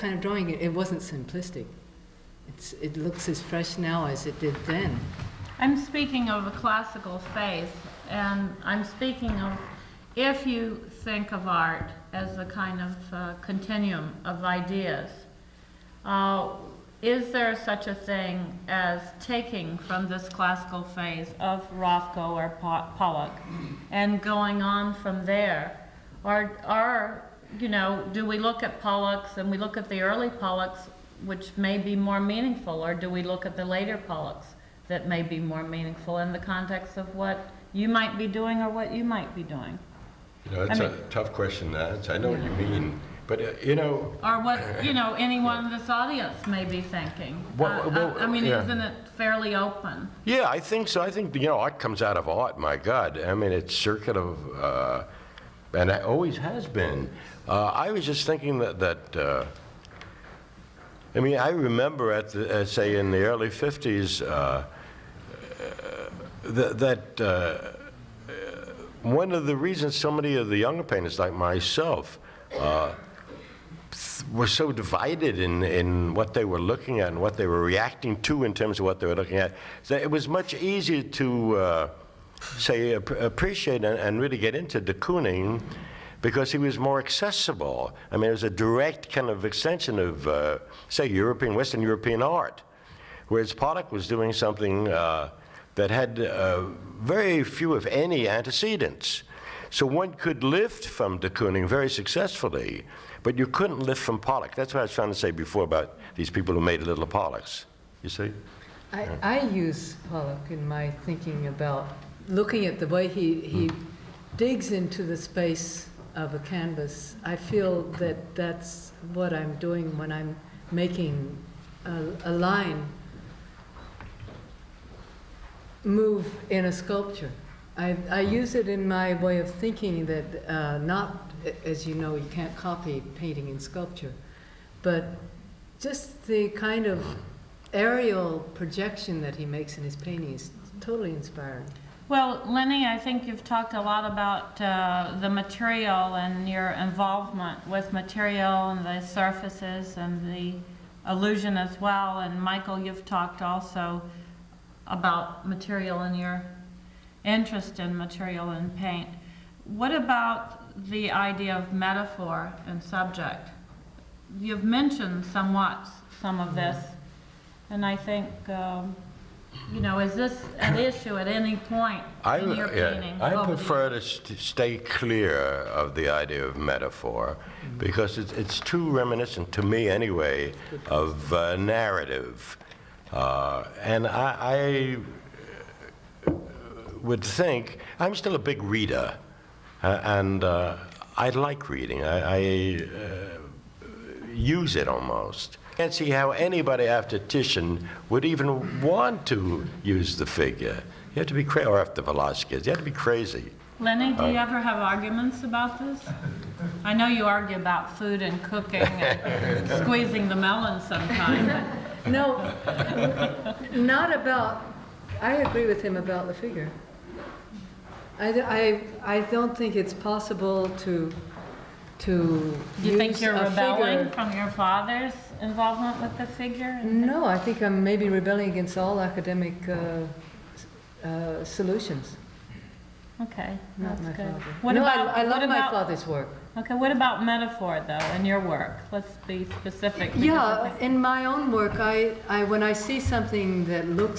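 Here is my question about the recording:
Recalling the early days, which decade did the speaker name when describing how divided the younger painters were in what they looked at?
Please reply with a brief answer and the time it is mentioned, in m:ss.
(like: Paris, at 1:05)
the 50s, at 1:03.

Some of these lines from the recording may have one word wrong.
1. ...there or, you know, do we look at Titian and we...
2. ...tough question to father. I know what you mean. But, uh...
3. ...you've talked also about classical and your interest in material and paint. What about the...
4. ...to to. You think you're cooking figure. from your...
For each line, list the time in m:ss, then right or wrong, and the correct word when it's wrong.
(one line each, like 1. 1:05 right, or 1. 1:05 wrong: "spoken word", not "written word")
1. 0:25 wrong: "Pollocks", not "Titian"
2. 0:41 wrong: "answer", not "father"
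3. 2:32 wrong: "material", not "classical"
4. 3:40 wrong: "rebelling", not "cooking".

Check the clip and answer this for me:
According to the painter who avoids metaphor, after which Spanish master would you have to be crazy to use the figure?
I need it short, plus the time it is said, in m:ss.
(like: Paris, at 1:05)
Velazquez, at 3:22.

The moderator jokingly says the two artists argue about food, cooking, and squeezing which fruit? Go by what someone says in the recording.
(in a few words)
melon.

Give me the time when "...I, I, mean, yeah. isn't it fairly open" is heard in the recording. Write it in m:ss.
0:48.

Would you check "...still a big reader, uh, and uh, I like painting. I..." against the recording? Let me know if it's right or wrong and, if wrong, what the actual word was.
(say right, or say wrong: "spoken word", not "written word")
wrong: "reading", not "painting".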